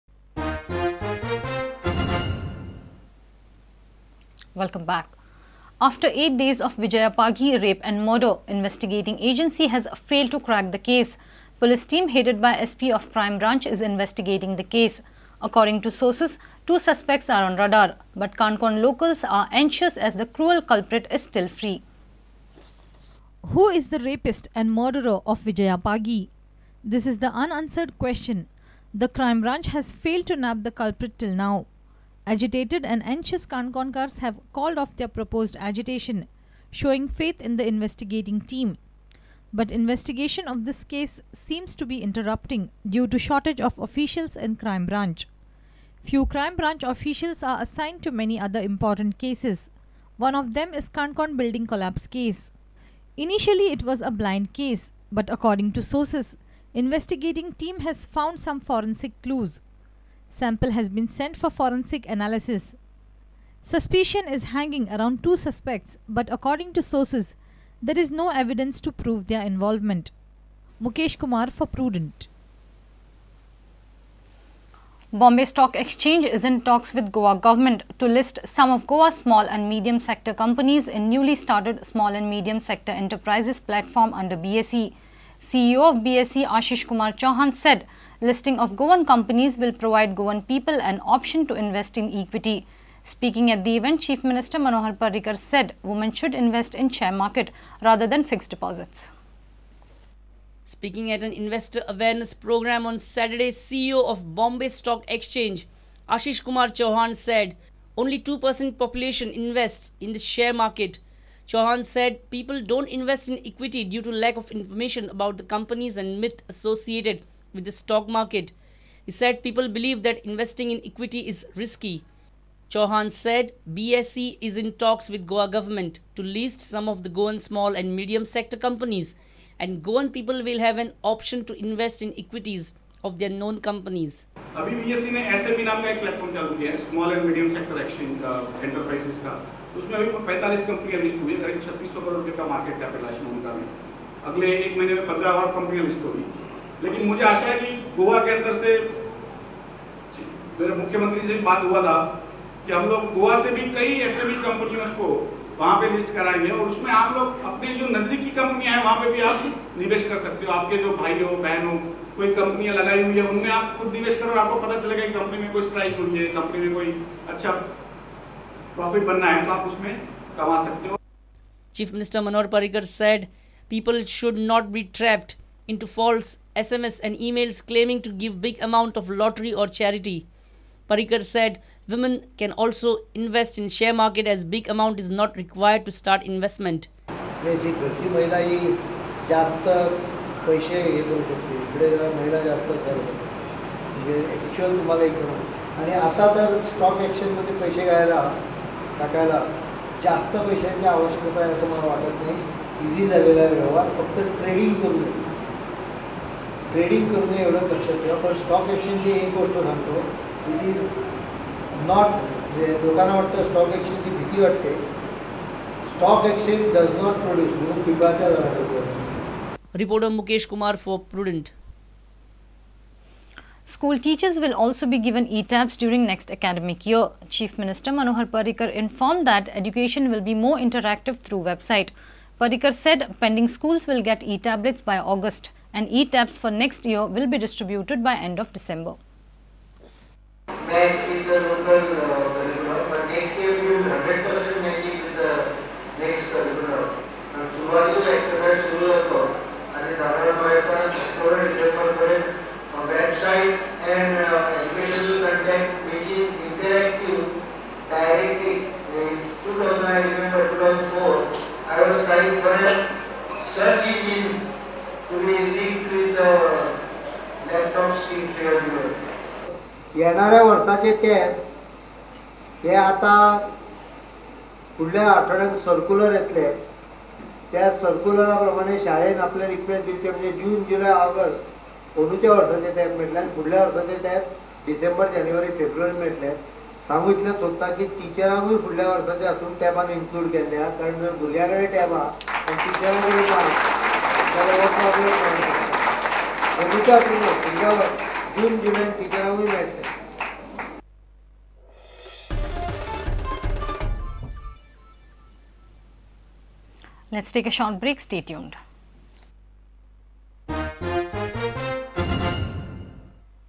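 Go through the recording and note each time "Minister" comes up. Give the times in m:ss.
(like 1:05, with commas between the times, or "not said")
1:34, 3:47.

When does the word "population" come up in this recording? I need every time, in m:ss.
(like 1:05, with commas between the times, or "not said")
1:48.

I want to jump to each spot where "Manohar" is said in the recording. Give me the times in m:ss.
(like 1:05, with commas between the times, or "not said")
1:34, 3:47.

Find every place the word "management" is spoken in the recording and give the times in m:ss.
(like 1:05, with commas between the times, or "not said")
not said.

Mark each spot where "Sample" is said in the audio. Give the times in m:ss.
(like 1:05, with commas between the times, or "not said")
1:00.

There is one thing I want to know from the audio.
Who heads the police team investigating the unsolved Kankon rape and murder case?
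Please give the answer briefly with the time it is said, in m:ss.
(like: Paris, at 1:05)
SP of Crime Branch, at 0:12.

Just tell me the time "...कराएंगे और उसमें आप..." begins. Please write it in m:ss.
2:36.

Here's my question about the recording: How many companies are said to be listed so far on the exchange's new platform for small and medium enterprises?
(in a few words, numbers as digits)
45.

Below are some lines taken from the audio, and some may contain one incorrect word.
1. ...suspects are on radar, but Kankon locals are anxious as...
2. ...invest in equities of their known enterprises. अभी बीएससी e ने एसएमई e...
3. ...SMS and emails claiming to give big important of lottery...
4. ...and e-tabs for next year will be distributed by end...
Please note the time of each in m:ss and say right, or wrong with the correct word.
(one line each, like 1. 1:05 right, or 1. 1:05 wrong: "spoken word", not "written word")
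1. 0:16 right
2. 2:11 wrong: "companies", not "enterprises"
3. 2:56 wrong: "amount", not "important"
4. 3:55 right.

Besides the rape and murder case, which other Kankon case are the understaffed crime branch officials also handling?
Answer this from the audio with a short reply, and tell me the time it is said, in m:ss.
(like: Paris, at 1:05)
Kankon building collapse case, at 0:50.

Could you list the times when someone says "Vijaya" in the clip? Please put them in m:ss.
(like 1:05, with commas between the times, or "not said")
0:06, 0:25.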